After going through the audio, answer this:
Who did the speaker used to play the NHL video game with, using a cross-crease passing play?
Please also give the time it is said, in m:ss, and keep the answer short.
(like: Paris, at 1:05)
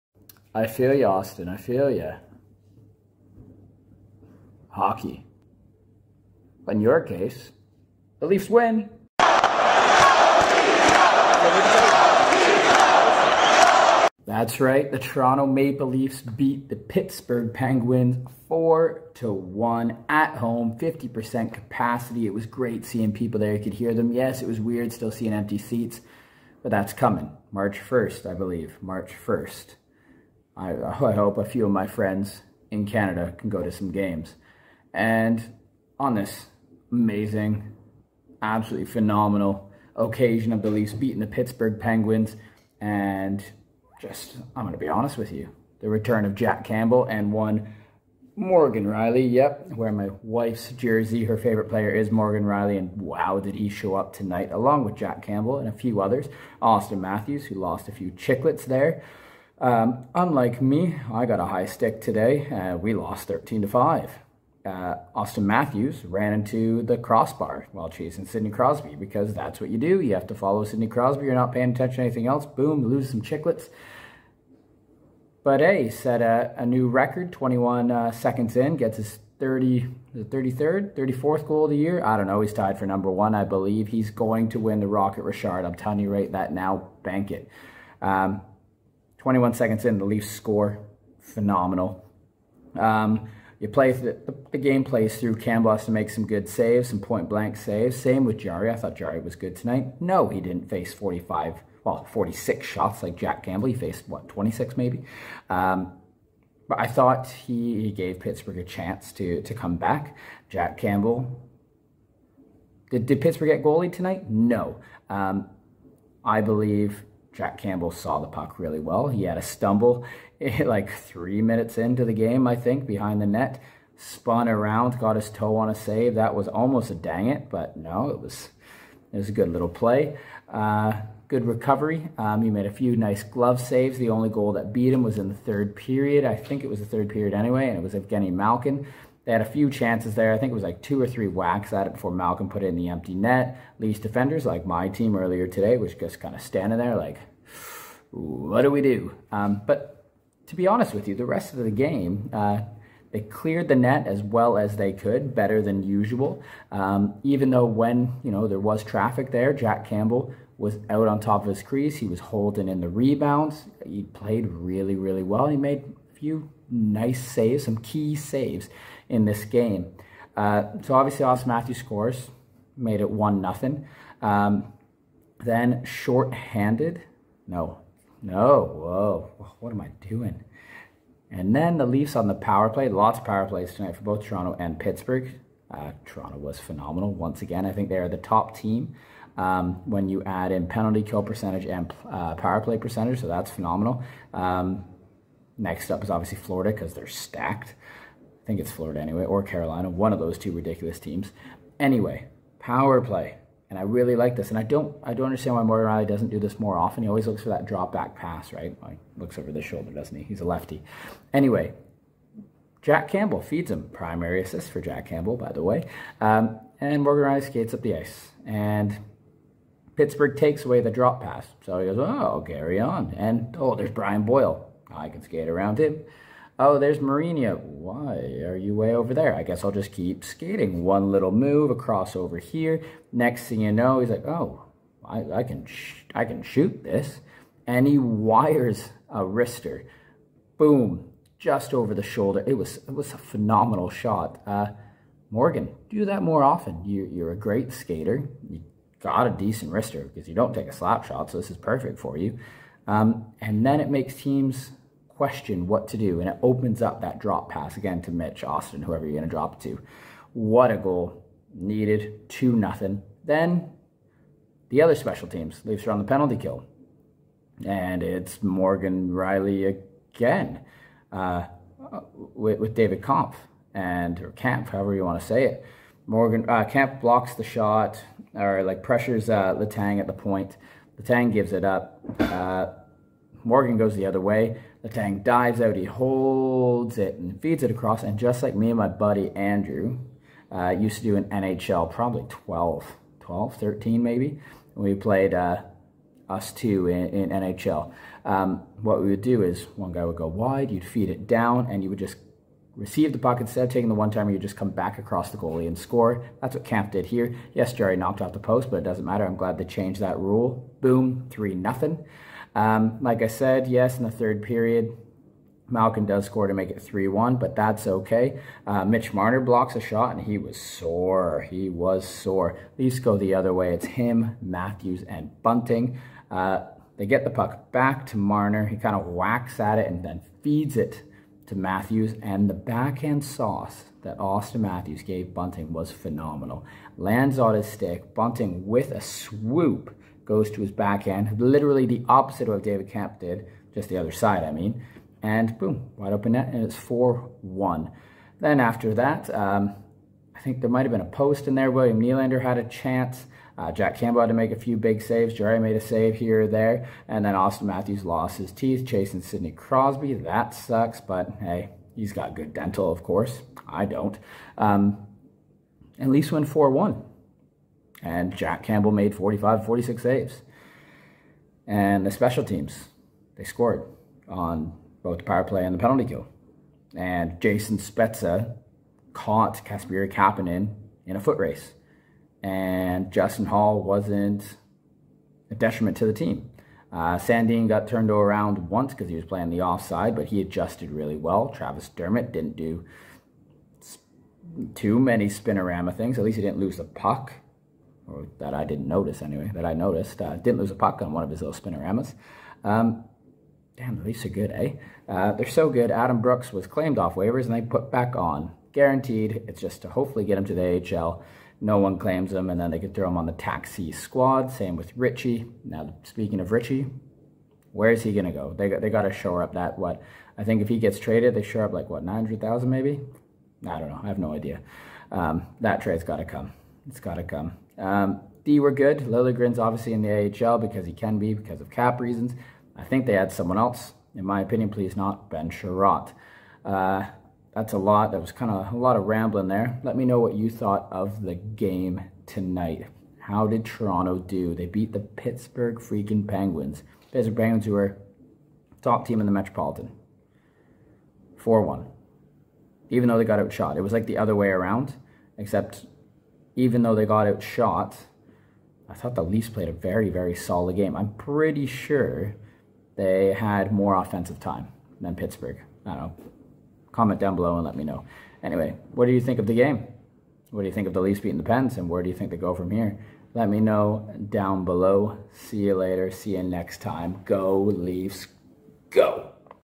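Andrew, at 4:48.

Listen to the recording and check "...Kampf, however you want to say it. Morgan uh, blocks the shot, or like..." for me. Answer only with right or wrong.
right.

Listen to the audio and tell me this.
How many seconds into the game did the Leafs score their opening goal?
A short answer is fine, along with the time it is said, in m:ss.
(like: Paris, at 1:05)
21, at 1:29.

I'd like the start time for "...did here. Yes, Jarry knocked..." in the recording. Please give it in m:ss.
5:06.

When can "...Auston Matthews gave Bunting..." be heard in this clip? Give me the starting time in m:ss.
5:34.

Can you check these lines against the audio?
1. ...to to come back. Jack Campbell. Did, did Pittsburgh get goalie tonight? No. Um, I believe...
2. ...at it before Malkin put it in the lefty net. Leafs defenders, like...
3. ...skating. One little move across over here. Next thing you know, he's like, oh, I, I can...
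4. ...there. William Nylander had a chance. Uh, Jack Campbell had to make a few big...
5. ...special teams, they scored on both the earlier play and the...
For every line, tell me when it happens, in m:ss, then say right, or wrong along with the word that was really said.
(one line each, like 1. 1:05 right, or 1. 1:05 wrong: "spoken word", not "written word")
1. 1:49 right
2. 2:21 wrong: "empty", not "lefty"
3. 3:50 right
4. 5:51 right
5. 6:12 wrong: "power", not "earlier".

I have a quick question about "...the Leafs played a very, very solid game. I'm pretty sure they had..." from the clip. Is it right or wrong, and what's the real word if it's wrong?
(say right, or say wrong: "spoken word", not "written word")
right.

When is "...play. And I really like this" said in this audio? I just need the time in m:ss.
3:22.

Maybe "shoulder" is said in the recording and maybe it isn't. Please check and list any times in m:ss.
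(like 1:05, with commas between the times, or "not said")
3:29, 4:02.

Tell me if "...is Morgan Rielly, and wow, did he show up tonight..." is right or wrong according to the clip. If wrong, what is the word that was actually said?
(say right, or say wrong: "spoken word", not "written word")
right.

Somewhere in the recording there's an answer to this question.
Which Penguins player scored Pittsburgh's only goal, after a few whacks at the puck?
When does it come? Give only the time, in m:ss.
2:17.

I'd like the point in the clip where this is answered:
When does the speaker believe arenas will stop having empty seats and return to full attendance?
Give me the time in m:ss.
0:26.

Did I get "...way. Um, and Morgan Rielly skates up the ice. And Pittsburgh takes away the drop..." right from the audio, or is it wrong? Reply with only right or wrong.
right.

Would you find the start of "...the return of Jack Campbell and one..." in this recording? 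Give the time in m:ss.
0:45.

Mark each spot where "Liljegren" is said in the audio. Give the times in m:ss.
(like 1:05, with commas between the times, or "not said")
7:08.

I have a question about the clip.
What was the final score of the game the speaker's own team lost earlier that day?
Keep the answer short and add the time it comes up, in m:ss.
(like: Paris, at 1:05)
13 to 5, at 1:03.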